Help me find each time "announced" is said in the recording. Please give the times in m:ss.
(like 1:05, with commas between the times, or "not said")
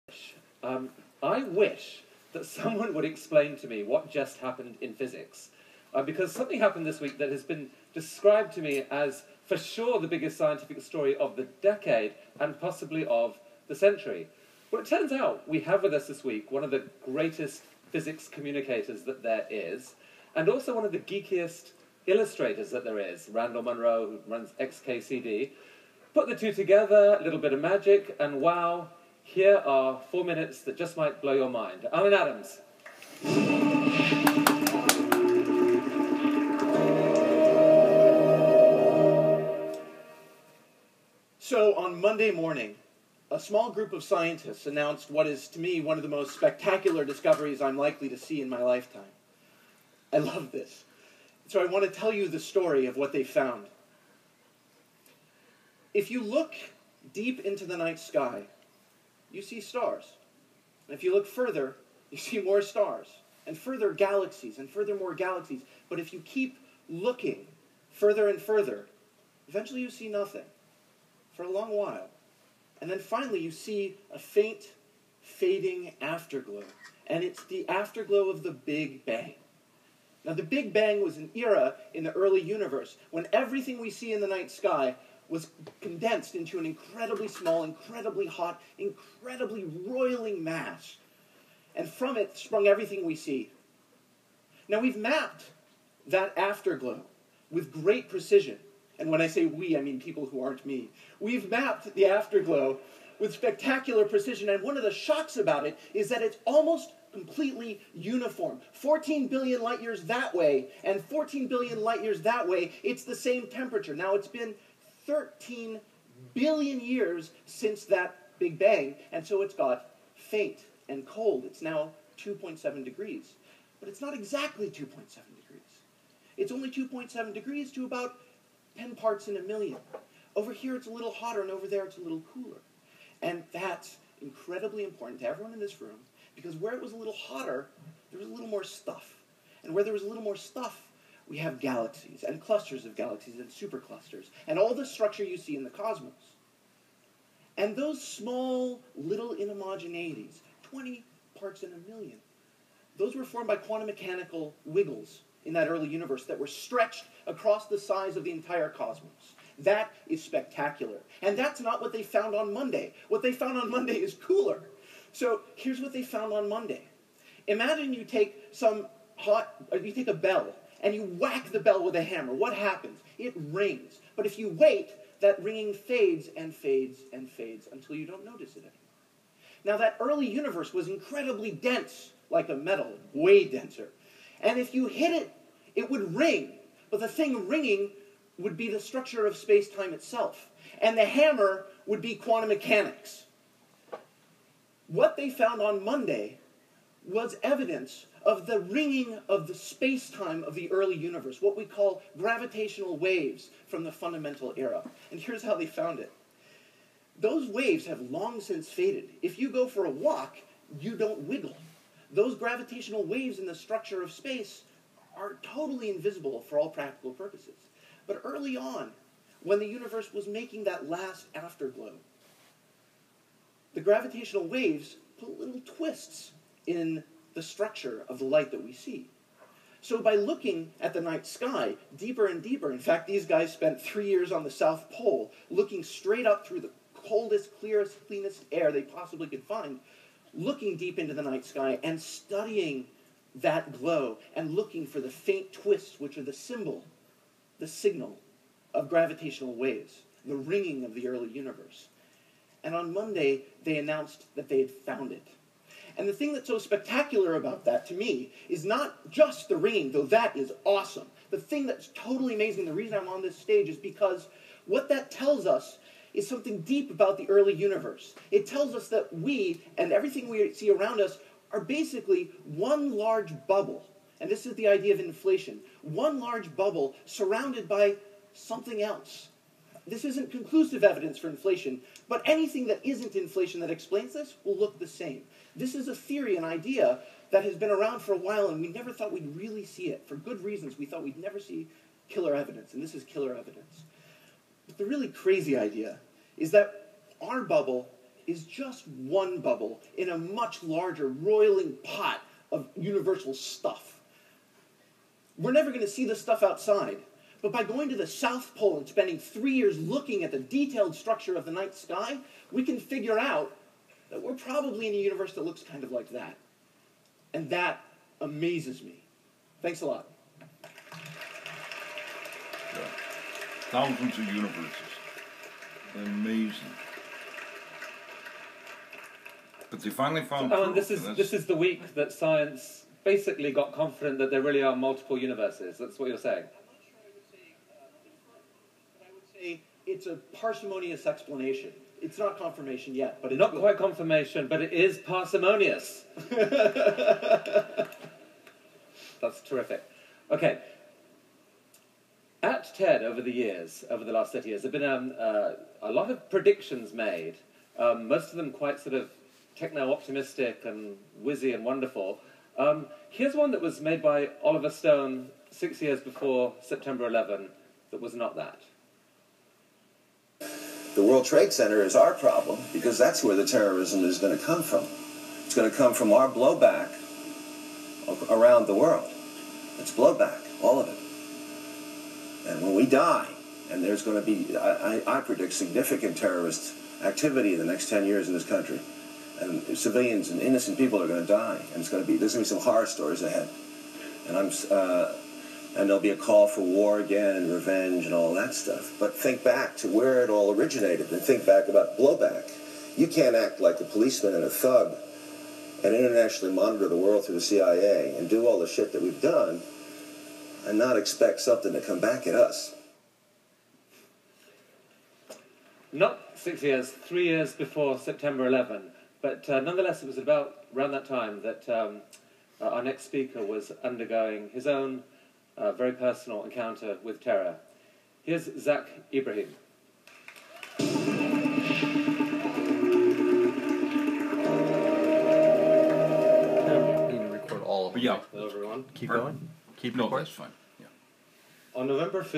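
0:44, 4:13.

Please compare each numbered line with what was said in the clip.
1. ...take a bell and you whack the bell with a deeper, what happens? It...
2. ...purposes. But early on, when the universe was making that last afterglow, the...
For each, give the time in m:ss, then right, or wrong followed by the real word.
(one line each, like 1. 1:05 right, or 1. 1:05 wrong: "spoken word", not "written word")
1. 2:49 wrong: "hammer", not "deeper"
2. 3:37 right.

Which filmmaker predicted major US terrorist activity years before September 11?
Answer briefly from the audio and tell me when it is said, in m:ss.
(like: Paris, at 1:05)
Oliver Stone, at 6:04.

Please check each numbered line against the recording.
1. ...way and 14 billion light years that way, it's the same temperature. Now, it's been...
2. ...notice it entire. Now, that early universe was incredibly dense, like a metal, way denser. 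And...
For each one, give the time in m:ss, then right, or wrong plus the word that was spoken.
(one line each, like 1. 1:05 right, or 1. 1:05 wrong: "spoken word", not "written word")
1. 1:50 right
2. 2:58 wrong: "anymore", not "entire".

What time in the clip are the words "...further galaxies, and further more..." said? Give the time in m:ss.
1:03.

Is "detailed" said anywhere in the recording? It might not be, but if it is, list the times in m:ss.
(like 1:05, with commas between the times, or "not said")
5:10.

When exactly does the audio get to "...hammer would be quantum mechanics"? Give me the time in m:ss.
3:11.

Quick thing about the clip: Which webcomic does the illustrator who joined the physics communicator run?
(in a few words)
XKCD.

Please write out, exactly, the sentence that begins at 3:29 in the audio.
If you go for a walk, you don't wiggle.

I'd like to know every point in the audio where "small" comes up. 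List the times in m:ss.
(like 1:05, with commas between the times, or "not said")
0:43, 1:27, 2:28.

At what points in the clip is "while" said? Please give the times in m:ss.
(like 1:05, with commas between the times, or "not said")
1:11, 4:48.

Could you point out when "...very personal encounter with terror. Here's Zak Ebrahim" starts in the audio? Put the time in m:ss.
7:05.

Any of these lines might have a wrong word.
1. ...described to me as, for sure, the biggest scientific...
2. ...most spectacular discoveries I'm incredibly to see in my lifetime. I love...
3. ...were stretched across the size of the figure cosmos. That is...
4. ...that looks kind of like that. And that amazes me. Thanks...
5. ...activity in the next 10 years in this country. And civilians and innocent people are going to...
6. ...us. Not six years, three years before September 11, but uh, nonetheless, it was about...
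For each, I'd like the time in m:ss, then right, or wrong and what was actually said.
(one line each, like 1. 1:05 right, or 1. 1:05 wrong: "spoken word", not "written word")
1. 0:07 right
2. 0:46 wrong: "likely", not "incredibly"
3. 2:36 wrong: "entire", not "figure"
4. 5:15 right
5. 6:27 right
6. 6:52 right.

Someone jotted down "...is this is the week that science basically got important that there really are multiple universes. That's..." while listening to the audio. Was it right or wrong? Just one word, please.
wrong.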